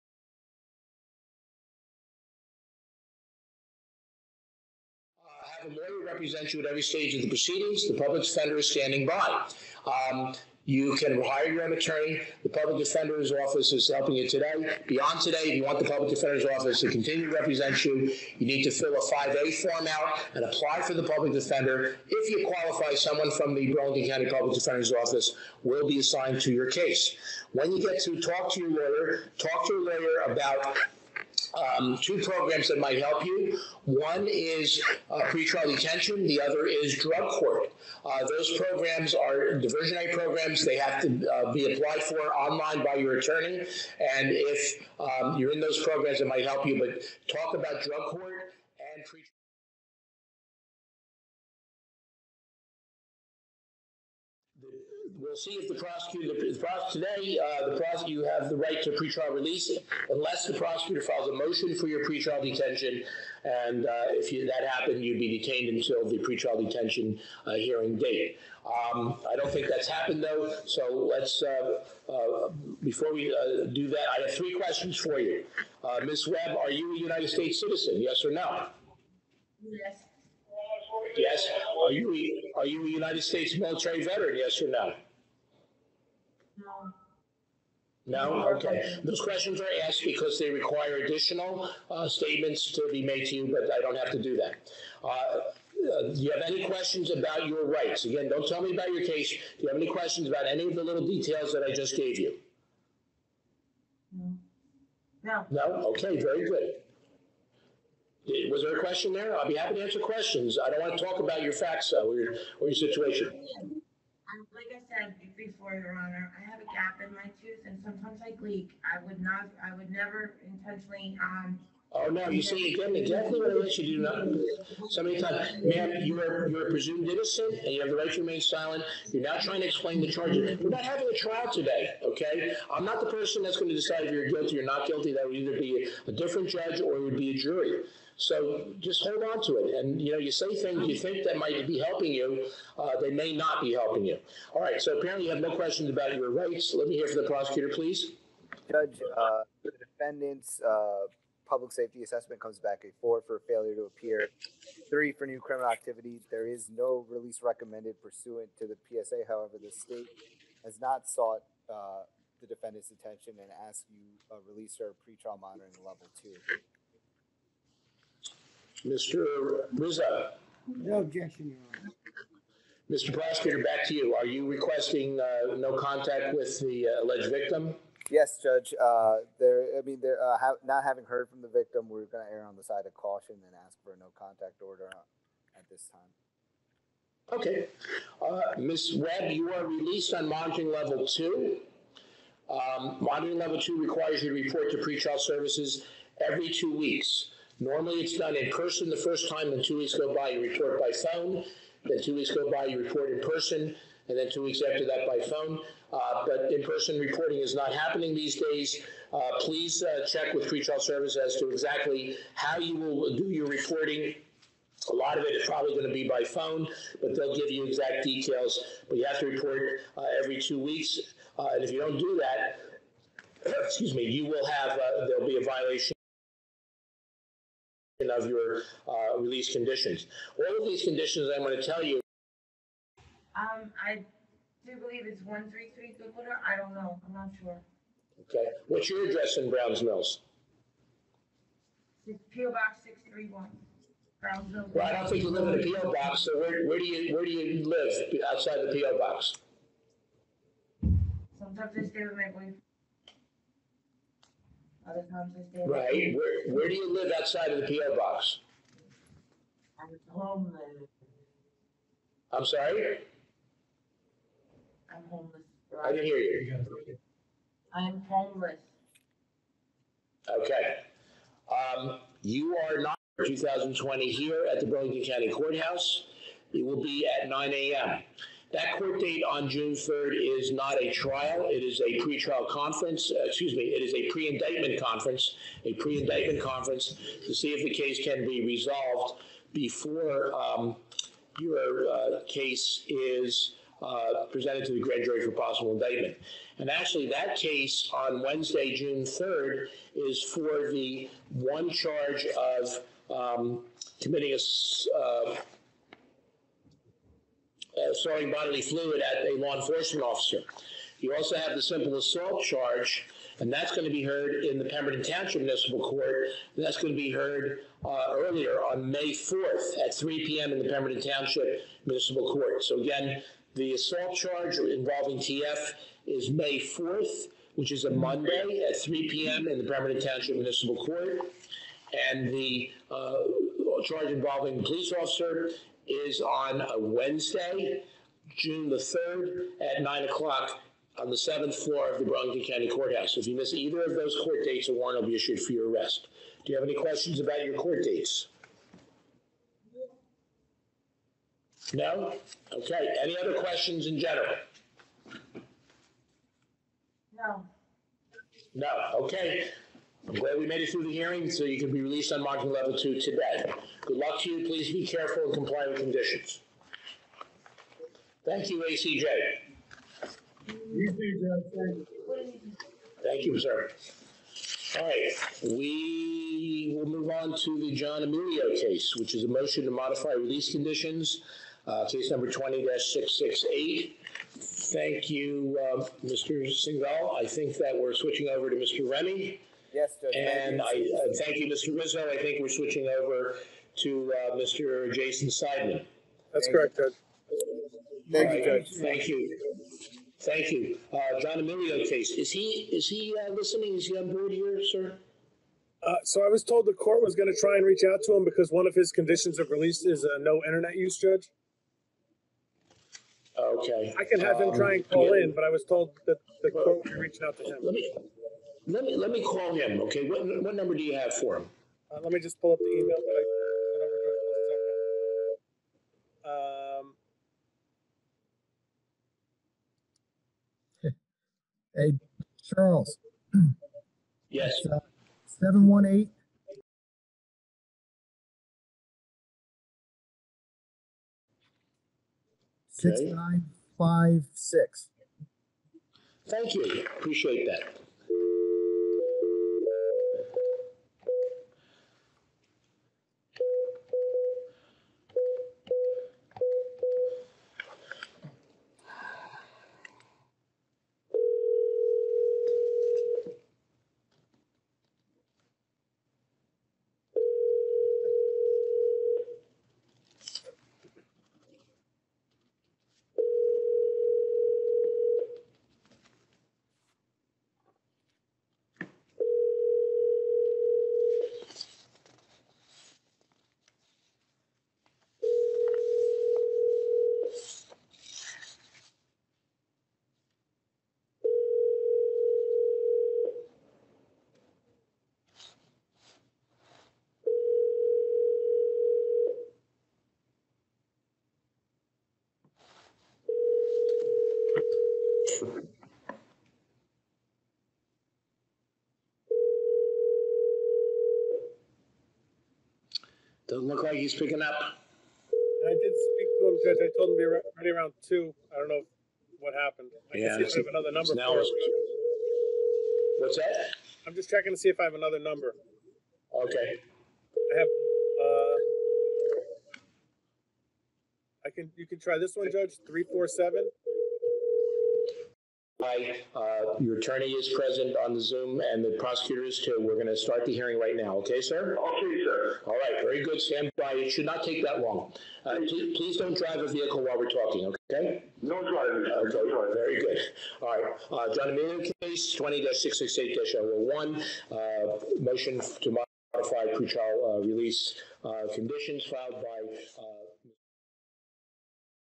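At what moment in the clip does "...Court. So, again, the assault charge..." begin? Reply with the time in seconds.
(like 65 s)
322 s.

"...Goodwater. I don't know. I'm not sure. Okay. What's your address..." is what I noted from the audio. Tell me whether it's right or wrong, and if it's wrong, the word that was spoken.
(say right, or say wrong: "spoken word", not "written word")
right.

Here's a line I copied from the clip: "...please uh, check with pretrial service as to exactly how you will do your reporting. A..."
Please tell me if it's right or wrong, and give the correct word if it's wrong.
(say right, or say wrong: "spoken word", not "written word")
right.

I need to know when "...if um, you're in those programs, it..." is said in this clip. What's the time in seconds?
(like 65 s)
44 s.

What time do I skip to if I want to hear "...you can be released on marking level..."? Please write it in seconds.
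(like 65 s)
361 s.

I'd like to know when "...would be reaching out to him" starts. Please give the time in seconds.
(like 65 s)
416 s.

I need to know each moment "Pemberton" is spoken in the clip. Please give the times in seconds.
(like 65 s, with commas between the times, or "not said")
314 s, 320 s, 329 s.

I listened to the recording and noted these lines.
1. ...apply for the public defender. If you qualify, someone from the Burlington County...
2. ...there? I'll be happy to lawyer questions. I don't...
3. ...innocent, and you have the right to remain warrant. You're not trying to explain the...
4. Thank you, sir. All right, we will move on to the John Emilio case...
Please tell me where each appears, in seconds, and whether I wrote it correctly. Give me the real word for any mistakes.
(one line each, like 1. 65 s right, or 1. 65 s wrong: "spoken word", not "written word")
1. 20 s right
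2. 109 s wrong: "answer", not "lawyer"
3. 127 s wrong: "silent", not "warrant"
4. 373 s right.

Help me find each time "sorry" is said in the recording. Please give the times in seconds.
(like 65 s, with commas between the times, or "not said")
262 s.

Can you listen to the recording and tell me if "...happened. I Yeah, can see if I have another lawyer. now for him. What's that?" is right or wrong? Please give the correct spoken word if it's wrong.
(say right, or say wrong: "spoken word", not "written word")
wrong: "number", not "lawyer".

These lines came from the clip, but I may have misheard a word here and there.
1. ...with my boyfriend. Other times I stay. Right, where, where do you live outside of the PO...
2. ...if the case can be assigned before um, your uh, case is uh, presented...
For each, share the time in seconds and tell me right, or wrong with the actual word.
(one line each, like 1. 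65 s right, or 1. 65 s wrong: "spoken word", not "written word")
1. 252 s right
2. 287 s wrong: "resolved", not "assigned".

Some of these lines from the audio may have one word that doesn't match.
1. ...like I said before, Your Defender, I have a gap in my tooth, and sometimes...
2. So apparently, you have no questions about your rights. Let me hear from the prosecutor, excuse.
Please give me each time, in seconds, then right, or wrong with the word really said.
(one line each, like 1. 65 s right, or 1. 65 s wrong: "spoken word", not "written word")
1. 114 s wrong: "Honor", not "Defender"
2. 144 s wrong: "please", not "excuse".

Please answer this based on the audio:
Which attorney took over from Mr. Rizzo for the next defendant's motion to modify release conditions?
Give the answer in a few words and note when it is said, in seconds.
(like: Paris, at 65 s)
Jason Seidman, at 394 s.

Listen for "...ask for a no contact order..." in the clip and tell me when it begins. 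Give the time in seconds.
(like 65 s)
183 s.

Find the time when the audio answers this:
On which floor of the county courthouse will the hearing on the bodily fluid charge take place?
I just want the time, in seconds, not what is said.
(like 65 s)
341 s.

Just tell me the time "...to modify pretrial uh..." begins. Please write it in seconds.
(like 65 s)
555 s.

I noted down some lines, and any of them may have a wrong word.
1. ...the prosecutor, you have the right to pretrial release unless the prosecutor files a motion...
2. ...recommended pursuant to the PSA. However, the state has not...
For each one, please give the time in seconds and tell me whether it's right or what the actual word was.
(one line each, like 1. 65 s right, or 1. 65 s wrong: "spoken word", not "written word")
1. 57 s right
2. 157 s right.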